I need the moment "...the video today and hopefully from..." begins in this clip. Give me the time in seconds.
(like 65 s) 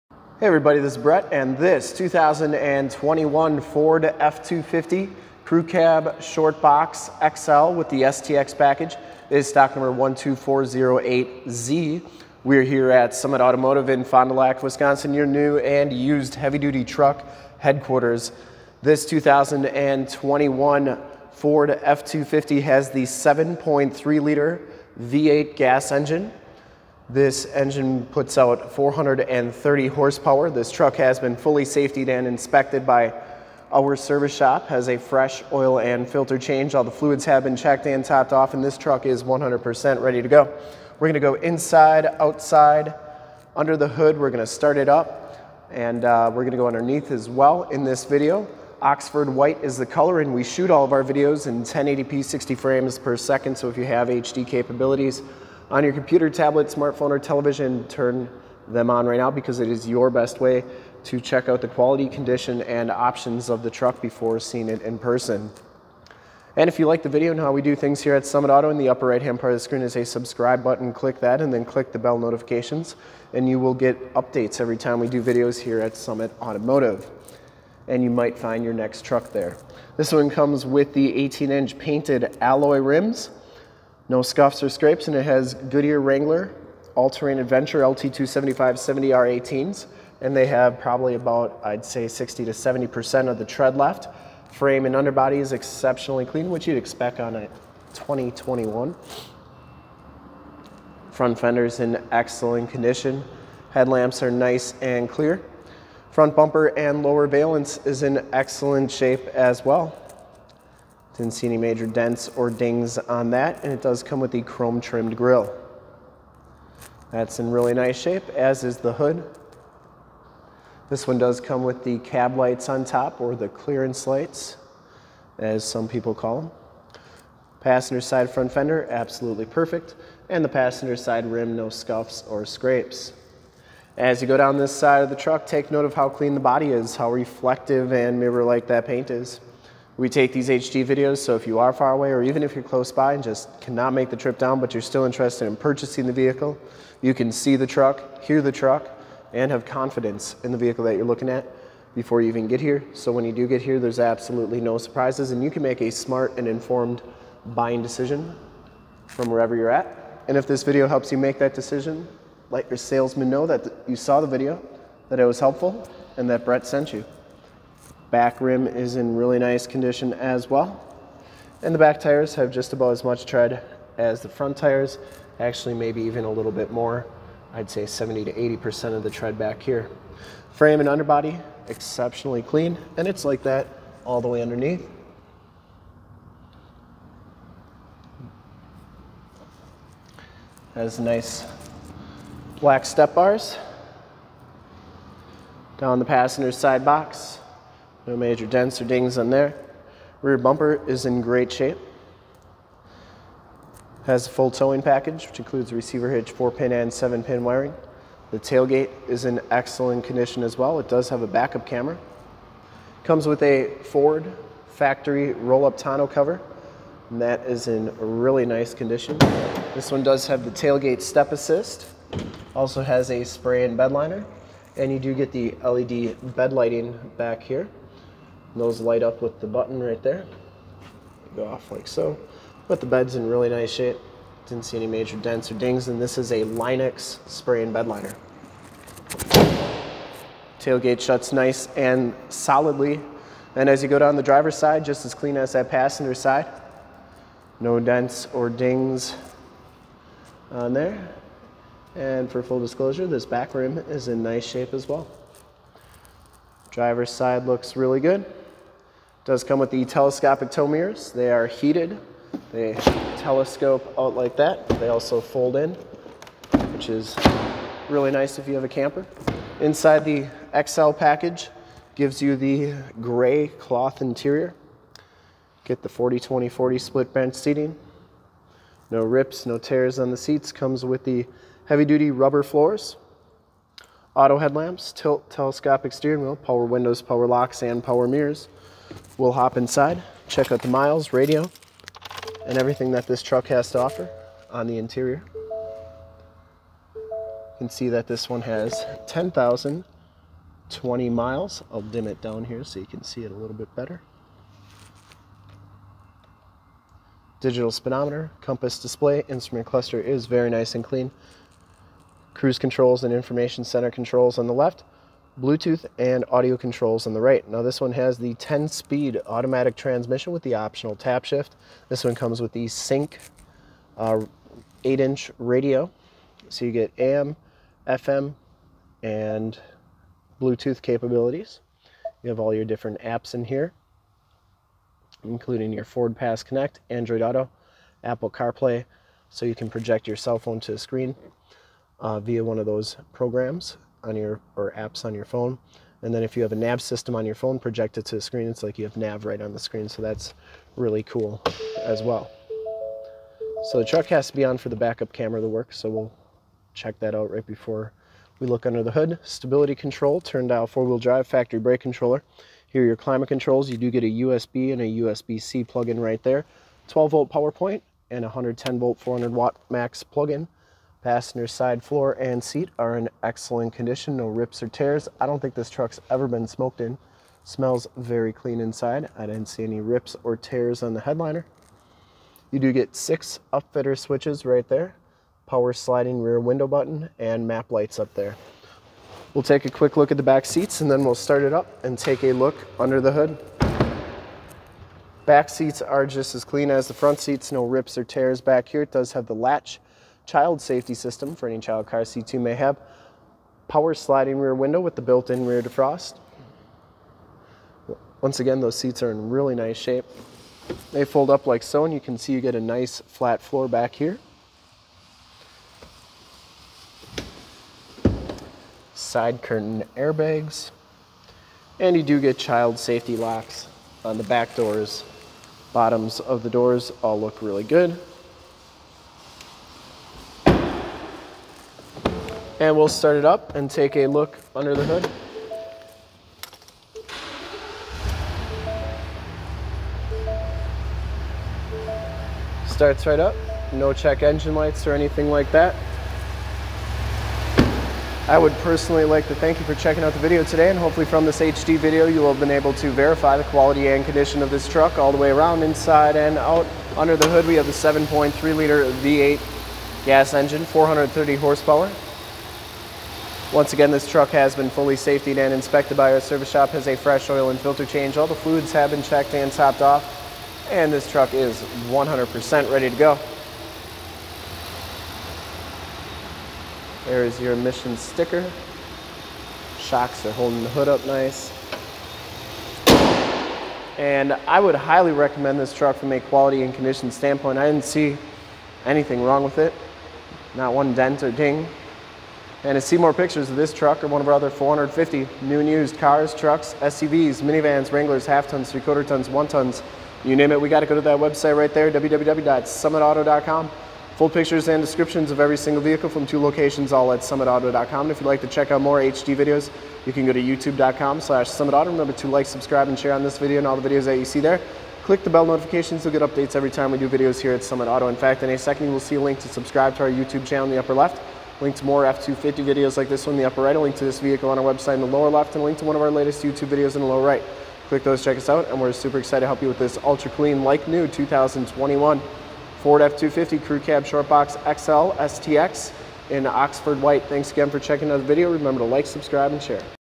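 450 s.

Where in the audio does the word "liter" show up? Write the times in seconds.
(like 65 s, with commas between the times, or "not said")
24 s, 458 s.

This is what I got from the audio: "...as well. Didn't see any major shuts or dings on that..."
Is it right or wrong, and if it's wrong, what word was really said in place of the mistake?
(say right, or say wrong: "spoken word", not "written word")
wrong: "dents", not "shuts".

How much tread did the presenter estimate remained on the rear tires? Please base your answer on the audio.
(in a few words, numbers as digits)
70 to 80%.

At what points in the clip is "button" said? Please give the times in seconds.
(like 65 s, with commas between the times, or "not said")
70 s, 229 s, 386 s.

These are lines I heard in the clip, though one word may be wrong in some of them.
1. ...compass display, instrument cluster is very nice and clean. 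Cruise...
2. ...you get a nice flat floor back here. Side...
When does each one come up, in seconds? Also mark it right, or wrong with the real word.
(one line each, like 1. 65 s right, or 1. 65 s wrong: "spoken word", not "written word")
1. 308 s right
2. 412 s right.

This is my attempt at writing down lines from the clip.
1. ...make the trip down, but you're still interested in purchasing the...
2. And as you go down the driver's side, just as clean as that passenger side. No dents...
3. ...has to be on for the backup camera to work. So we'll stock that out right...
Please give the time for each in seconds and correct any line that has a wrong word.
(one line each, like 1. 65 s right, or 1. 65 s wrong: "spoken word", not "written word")
1. 143 s right
2. 243 s right
3. 354 s wrong: "check", not "stock".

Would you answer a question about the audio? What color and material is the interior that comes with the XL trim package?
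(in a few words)
Gray cloth.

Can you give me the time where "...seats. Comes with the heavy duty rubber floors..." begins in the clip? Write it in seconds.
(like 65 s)
280 s.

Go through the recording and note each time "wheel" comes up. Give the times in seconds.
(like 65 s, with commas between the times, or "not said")
286 s, 360 s.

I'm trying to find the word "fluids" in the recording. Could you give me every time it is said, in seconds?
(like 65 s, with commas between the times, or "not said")
36 s, 468 s.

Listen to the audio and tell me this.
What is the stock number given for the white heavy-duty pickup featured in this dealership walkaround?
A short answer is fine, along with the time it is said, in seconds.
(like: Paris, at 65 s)
12408Z, at 9 s.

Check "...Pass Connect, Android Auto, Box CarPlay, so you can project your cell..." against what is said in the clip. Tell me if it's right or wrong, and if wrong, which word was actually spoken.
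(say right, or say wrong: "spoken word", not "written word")
wrong: "Apple", not "Box".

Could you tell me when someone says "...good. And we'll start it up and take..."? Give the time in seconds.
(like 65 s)
427 s.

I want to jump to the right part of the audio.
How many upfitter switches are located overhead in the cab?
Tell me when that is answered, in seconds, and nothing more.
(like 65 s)
382 s.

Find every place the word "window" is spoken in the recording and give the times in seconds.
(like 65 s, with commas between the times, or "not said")
286 s, 386 s, 404 s.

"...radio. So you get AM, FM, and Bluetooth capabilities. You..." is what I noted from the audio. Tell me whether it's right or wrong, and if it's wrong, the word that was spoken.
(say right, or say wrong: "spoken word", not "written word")
right.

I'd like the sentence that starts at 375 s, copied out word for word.
I don't think this truck's ever been smoked in.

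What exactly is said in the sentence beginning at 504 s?
Full pictures and descriptions of every single vehicle from two locations, all at summitauto.com.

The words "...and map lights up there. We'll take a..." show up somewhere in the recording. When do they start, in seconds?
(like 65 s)
387 s.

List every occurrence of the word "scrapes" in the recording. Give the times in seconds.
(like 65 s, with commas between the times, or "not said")
84 s, 132 s.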